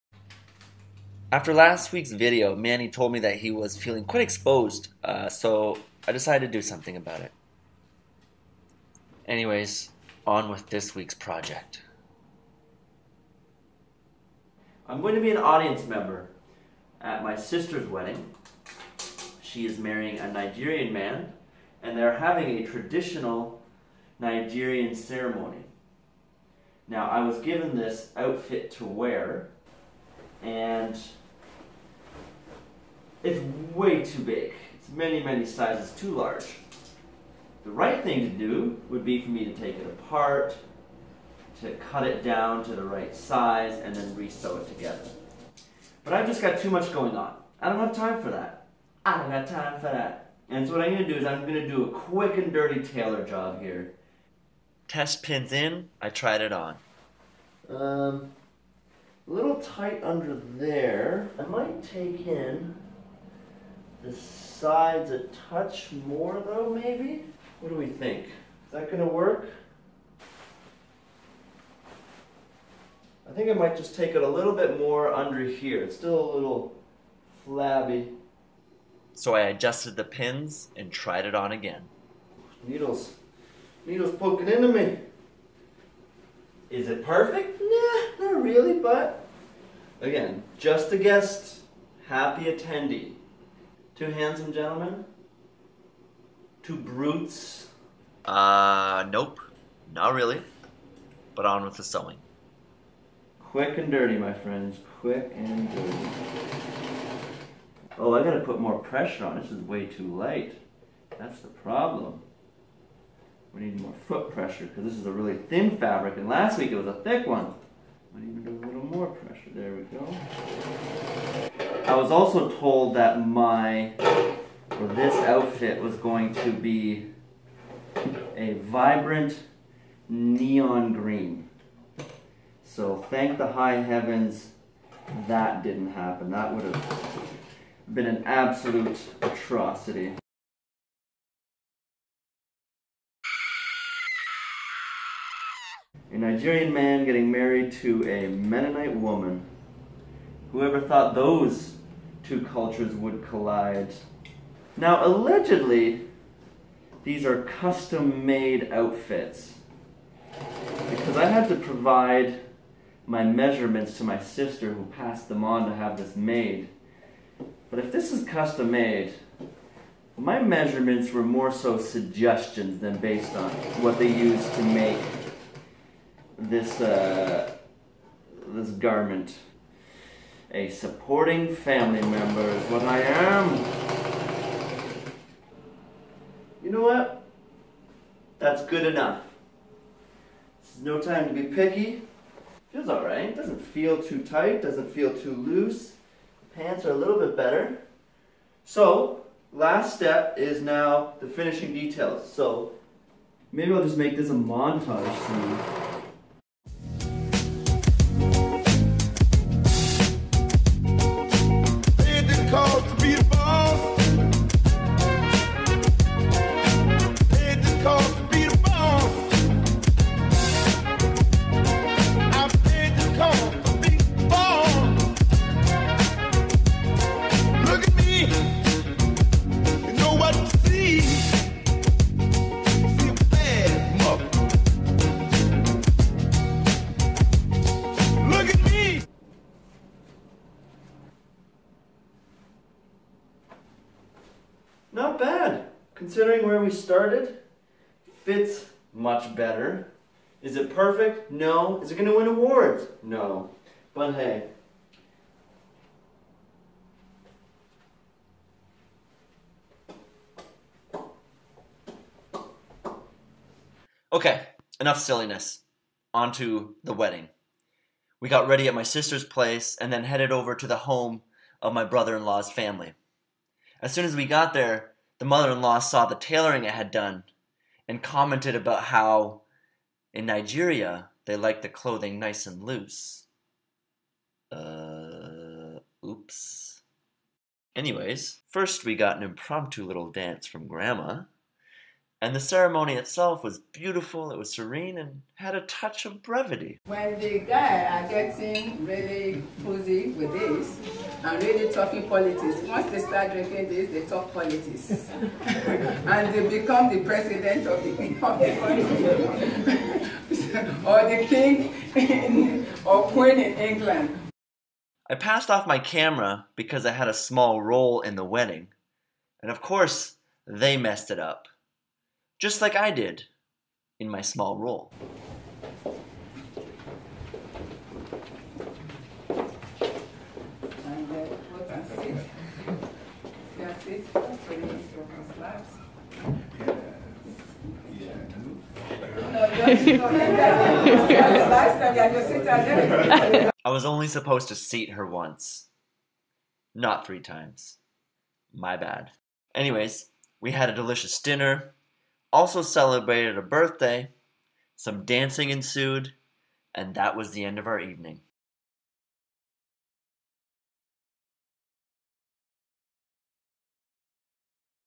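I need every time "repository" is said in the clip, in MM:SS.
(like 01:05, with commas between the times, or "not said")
not said.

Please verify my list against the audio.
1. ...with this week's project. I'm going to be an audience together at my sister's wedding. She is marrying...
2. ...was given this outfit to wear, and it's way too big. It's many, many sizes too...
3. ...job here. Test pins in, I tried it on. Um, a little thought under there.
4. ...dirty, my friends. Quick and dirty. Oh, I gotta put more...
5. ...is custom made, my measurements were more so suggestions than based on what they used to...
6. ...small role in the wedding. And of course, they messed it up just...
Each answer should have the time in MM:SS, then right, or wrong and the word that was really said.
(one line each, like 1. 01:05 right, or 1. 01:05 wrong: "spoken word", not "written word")
1. 00:10 wrong: "member", not "together"
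2. 00:27 right
3. 00:53 wrong: "tight", not "thought"
4. 01:43 right
5. 02:48 right
6. 05:17 right.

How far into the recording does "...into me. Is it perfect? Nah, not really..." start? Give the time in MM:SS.
01:24.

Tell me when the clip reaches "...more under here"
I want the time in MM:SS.
01:14.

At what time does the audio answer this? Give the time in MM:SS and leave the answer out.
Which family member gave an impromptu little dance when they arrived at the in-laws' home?
04:50.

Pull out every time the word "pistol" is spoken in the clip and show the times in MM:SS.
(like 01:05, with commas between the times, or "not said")
not said.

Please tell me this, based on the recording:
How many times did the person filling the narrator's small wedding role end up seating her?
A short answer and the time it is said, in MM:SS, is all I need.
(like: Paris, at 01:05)
3, at 05:47.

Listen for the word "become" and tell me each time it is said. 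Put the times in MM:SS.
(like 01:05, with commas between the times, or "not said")
05:06.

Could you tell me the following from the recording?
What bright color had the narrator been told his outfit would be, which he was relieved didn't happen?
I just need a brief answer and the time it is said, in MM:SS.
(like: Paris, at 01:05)
neon green, at 02:10.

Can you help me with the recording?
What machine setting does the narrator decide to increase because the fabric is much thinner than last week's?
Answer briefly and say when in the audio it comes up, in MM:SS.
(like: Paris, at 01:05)
foot pressure, at 01:54.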